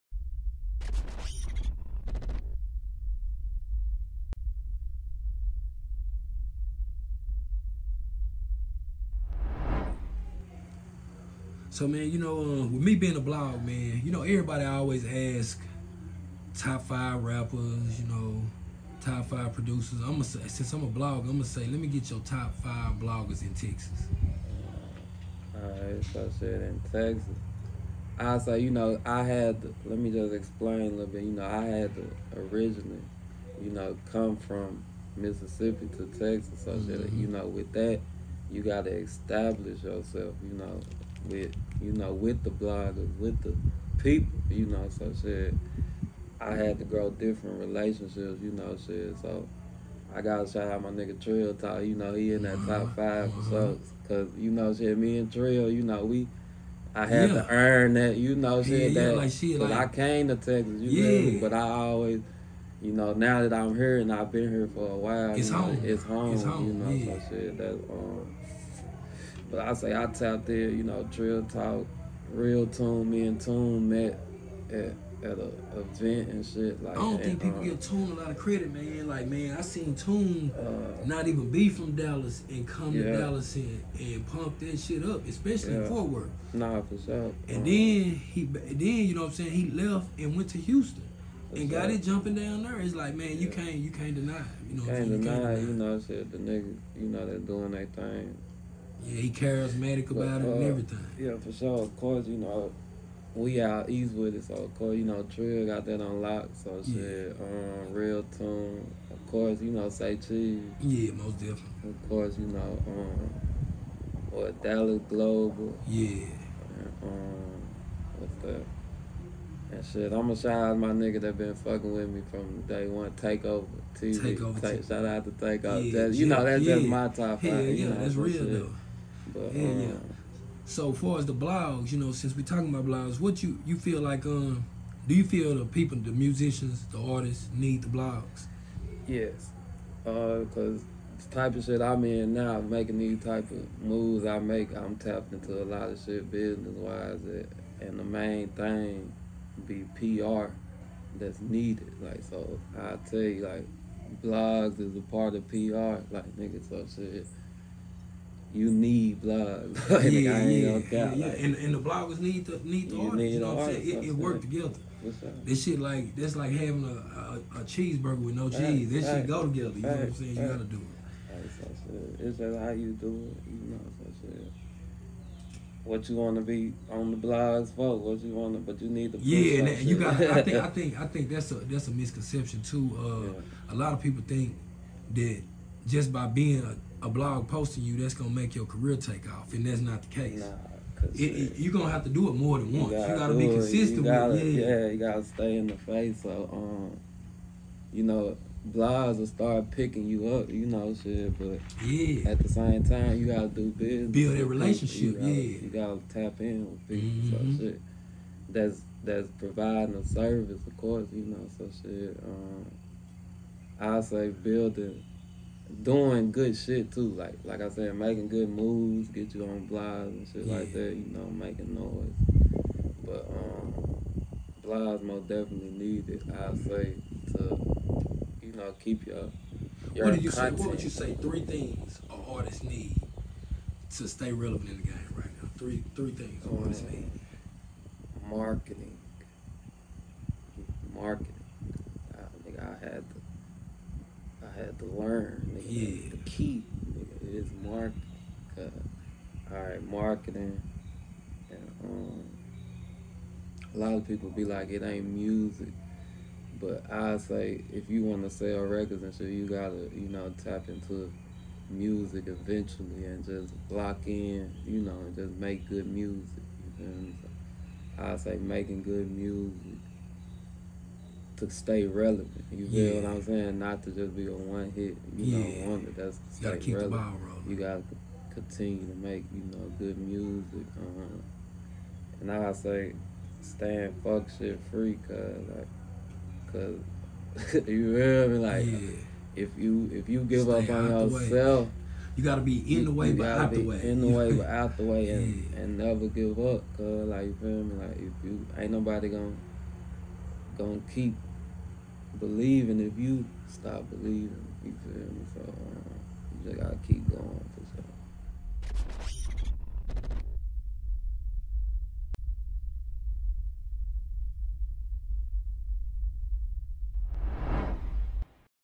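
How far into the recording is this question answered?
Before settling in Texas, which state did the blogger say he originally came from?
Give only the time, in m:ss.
0:35.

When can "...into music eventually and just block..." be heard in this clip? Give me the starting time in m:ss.
4:20.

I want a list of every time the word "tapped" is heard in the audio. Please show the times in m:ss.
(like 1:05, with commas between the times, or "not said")
1:10, 2:24.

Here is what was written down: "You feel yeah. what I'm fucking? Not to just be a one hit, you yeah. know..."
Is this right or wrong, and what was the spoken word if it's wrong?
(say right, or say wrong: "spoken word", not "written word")
wrong: "saying", not "fucking".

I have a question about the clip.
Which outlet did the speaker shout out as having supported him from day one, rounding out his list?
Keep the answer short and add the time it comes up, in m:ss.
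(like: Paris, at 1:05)
Takeover TV, at 2:03.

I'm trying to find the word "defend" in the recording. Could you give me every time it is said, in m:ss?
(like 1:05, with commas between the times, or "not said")
not said.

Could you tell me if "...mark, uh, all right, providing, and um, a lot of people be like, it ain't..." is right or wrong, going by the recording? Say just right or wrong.
wrong.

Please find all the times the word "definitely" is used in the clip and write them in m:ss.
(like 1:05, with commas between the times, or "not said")
1:51, 3:45.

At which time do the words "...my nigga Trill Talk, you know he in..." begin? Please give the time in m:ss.
0:50.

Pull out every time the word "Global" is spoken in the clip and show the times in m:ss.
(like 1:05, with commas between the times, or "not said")
1:55.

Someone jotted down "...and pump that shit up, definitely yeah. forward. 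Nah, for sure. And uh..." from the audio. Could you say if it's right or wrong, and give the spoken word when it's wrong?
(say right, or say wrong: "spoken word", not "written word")
wrong: "especially", not "definitely".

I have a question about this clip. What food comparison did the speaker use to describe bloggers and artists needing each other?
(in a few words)
a cheeseburger with no cheese.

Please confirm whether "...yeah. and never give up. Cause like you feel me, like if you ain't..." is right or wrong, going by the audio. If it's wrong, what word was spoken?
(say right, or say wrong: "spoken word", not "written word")
right.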